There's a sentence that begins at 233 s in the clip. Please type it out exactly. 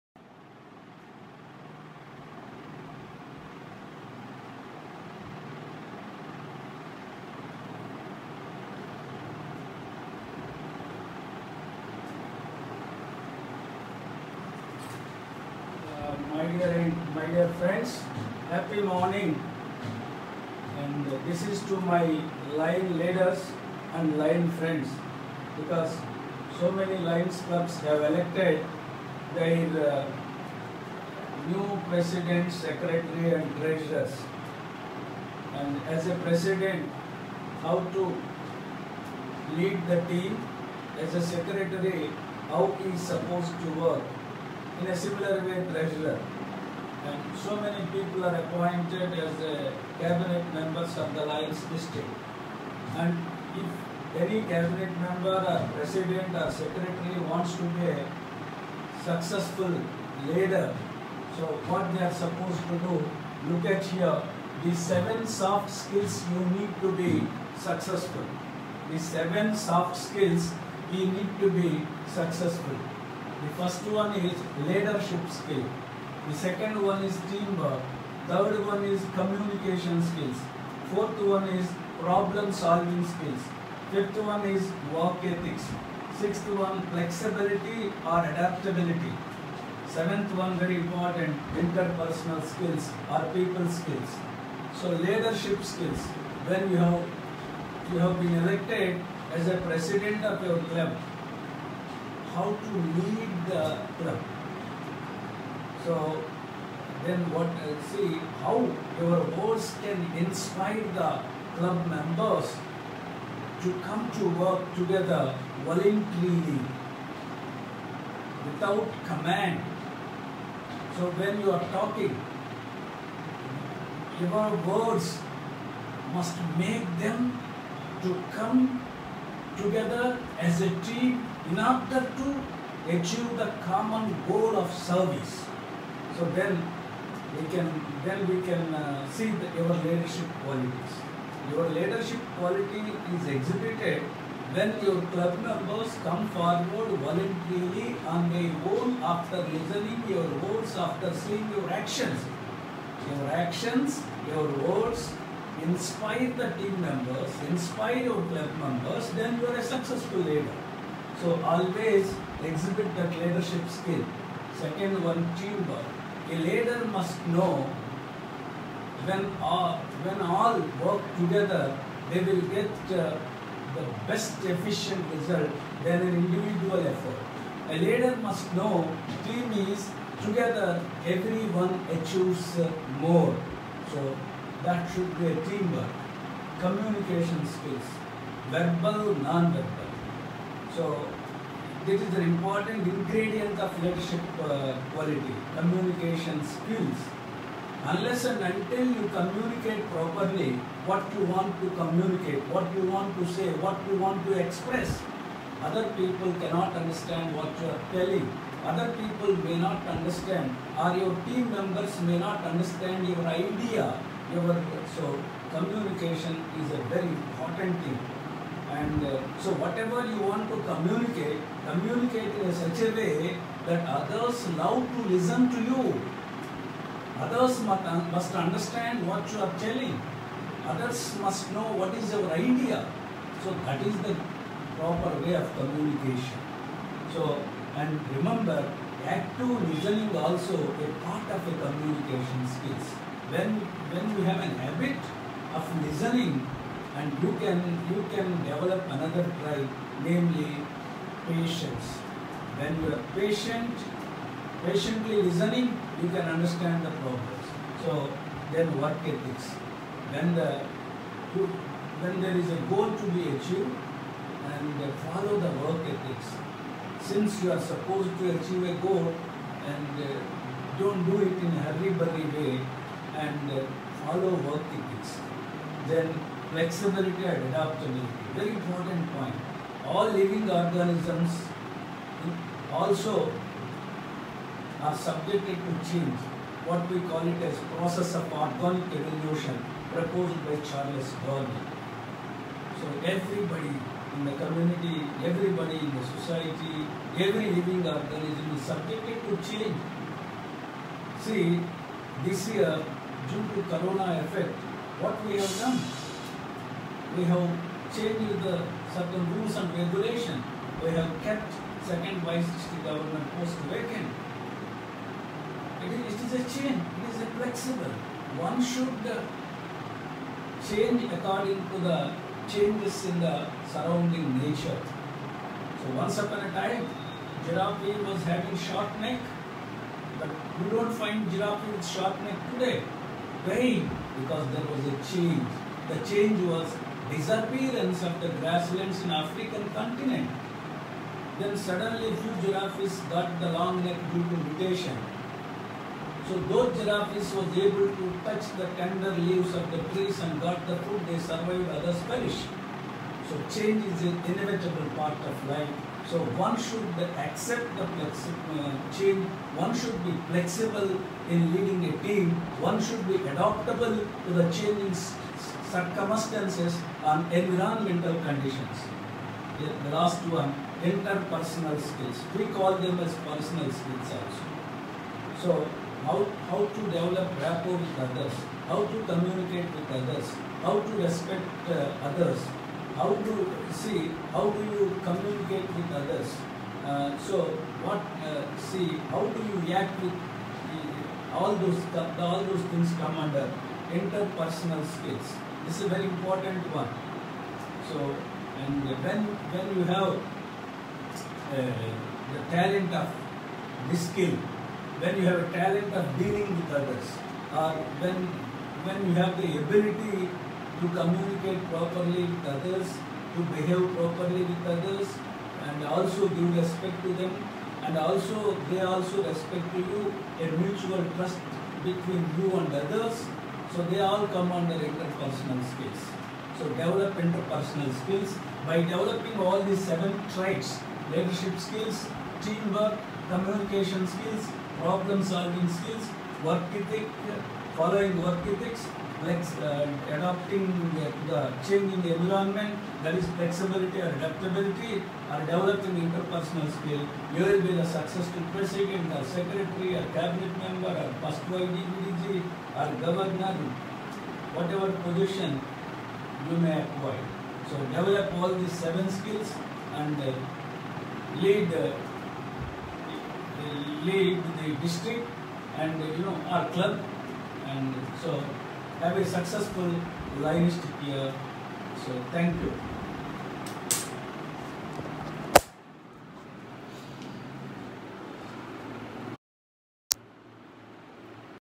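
So that is the proper way of communication.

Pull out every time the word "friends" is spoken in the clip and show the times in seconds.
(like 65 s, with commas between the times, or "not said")
17 s, 24 s.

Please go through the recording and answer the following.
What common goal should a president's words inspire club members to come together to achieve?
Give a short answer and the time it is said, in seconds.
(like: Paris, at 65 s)
Service, at 134 s.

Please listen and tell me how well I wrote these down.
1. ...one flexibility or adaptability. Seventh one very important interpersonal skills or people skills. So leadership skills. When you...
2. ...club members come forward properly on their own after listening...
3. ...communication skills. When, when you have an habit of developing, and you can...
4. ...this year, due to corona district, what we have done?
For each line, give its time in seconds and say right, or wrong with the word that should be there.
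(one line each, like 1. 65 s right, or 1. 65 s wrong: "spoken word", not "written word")
1. 86 s right
2. 145 s wrong: "voluntarily", not "properly"
3. 241 s wrong: "listening", not "developing"
4. 302 s wrong: "effect", not "district".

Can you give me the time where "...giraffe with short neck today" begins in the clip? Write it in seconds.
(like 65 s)
331 s.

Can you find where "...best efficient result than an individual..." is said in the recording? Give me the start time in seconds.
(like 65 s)
174 s.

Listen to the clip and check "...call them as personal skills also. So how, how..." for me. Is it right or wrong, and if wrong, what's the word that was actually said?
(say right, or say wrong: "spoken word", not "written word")
right.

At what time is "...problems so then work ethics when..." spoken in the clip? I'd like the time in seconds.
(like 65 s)
257 s.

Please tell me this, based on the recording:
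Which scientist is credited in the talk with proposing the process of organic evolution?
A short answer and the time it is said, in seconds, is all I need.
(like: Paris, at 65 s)
Charles Darwin, at 290 s.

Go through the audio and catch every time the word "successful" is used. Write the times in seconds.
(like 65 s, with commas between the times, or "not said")
59 s, 67 s, 72 s, 159 s, 447 s, 469 s.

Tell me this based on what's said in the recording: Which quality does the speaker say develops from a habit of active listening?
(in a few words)
Patience.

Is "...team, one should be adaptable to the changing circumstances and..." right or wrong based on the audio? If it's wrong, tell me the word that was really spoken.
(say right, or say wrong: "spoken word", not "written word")
right.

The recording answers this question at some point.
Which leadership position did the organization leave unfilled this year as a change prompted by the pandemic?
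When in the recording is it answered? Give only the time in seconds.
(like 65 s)
311 s.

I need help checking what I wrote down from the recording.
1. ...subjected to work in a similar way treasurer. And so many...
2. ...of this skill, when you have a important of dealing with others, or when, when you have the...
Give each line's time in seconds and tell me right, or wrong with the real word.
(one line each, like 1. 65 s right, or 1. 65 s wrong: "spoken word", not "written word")
1. 43 s wrong: "supposed", not "subjected"
2. 402 s wrong: "talent", not "important".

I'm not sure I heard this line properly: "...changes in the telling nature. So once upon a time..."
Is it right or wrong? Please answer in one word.
wrong.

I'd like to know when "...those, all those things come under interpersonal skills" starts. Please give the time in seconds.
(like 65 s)
391 s.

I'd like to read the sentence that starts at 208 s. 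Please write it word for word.
Other people may not understand or your team members may not understand your idea.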